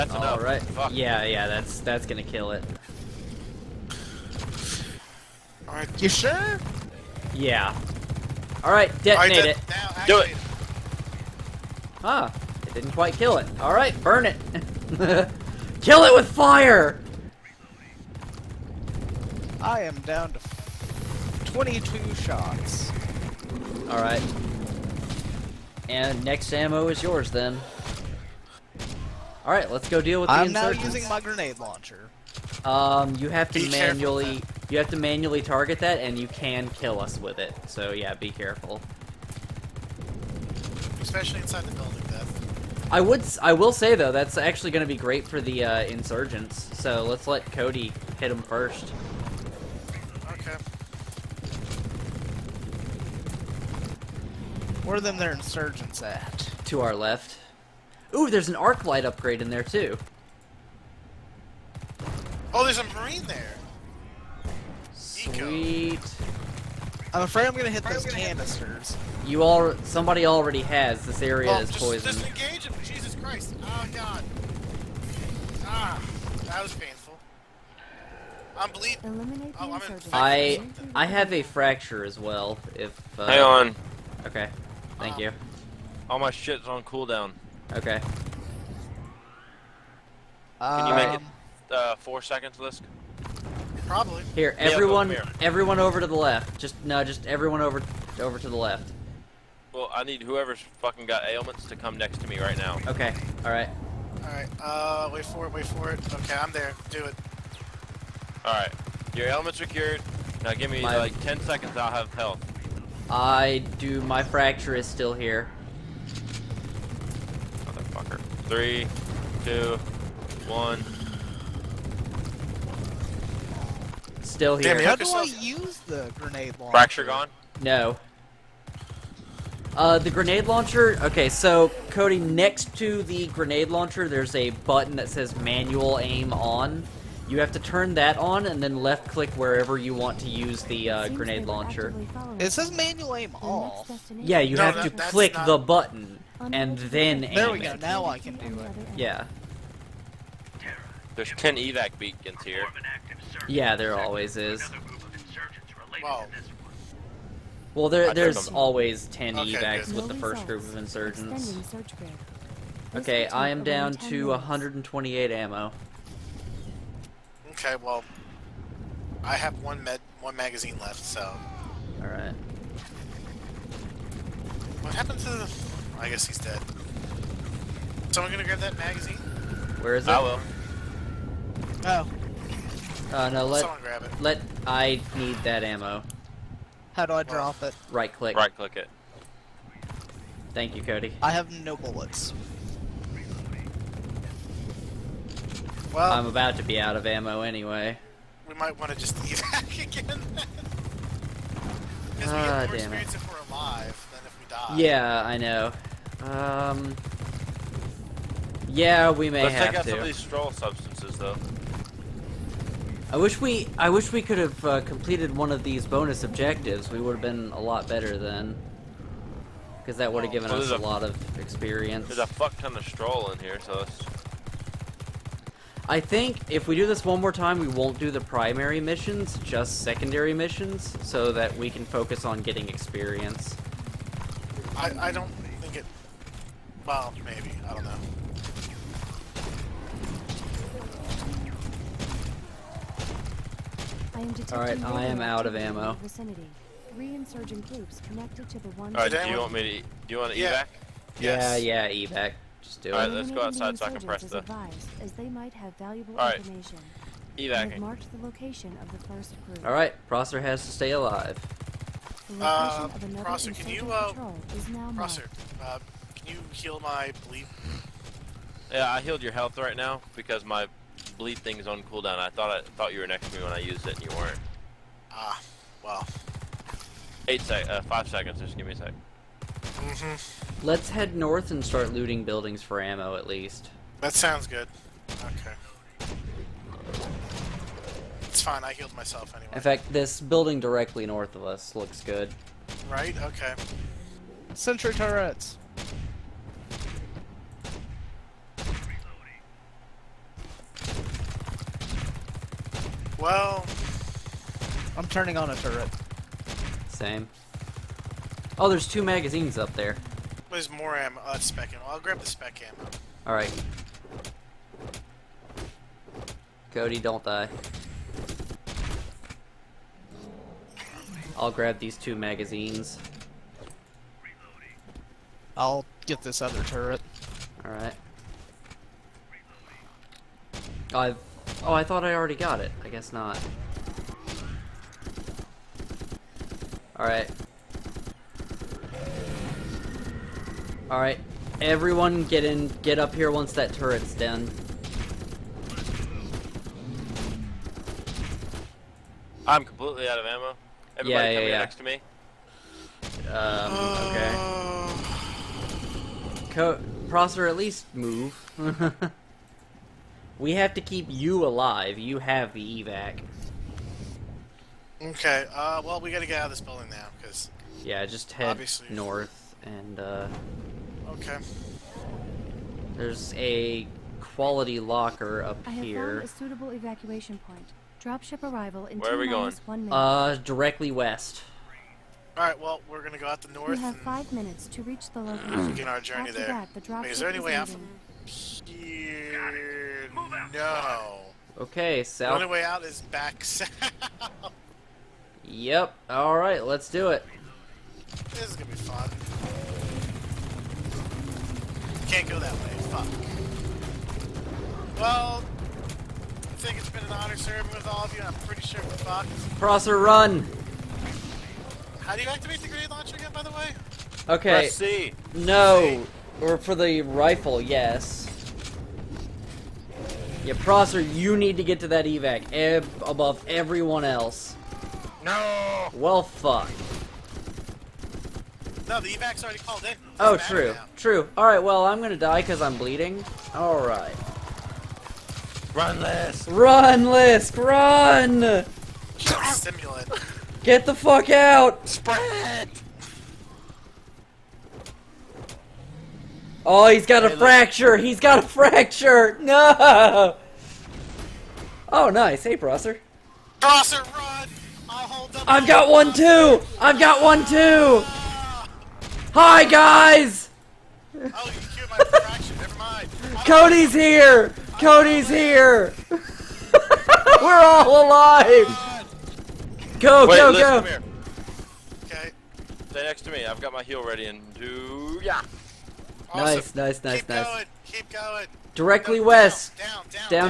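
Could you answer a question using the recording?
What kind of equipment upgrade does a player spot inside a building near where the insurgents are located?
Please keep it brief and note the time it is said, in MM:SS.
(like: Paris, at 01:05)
arc light upgrade, at 00:58.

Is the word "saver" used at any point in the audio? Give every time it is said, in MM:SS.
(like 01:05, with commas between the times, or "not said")
not said.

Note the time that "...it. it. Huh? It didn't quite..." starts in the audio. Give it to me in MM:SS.
00:10.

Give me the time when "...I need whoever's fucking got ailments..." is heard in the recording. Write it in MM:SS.
01:39.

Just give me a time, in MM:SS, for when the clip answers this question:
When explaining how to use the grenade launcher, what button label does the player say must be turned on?
02:15.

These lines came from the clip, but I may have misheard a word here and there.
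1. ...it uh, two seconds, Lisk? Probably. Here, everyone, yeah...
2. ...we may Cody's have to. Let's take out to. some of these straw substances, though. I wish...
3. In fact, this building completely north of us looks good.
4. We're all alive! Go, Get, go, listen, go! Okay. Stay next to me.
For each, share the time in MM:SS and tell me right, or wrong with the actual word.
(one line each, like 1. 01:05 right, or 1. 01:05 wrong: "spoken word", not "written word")
1. 01:31 wrong: "four", not "two"
2. 03:29 wrong: "Let", not "Cody"
3. 04:49 wrong: "directly", not "completely"
4. 07:47 wrong: "Wait", not "Get".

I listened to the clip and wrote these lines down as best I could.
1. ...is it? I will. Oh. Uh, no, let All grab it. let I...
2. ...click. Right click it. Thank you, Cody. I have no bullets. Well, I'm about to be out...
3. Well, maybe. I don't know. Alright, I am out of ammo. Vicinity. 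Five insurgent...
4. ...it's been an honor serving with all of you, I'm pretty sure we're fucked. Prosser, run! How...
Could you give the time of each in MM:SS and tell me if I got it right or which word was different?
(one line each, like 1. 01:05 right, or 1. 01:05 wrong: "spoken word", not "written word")
1. 02:59 wrong: "Someone", not "All"
2. 03:08 right
3. 03:56 wrong: "Three", not "Five"
4. 06:46 right.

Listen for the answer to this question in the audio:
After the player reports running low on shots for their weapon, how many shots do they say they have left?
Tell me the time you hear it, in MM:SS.
00:21.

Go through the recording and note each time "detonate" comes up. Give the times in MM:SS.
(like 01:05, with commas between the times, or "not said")
00:09.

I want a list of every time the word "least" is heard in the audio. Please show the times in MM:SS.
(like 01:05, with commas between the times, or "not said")
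04:43, 05:57.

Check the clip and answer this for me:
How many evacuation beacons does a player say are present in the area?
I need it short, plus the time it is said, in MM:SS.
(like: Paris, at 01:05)
10, at 02:31.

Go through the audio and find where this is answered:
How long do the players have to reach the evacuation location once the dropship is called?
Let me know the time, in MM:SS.
06:23.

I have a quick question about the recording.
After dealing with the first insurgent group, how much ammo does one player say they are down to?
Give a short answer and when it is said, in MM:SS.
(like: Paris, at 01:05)
128, at 02:44.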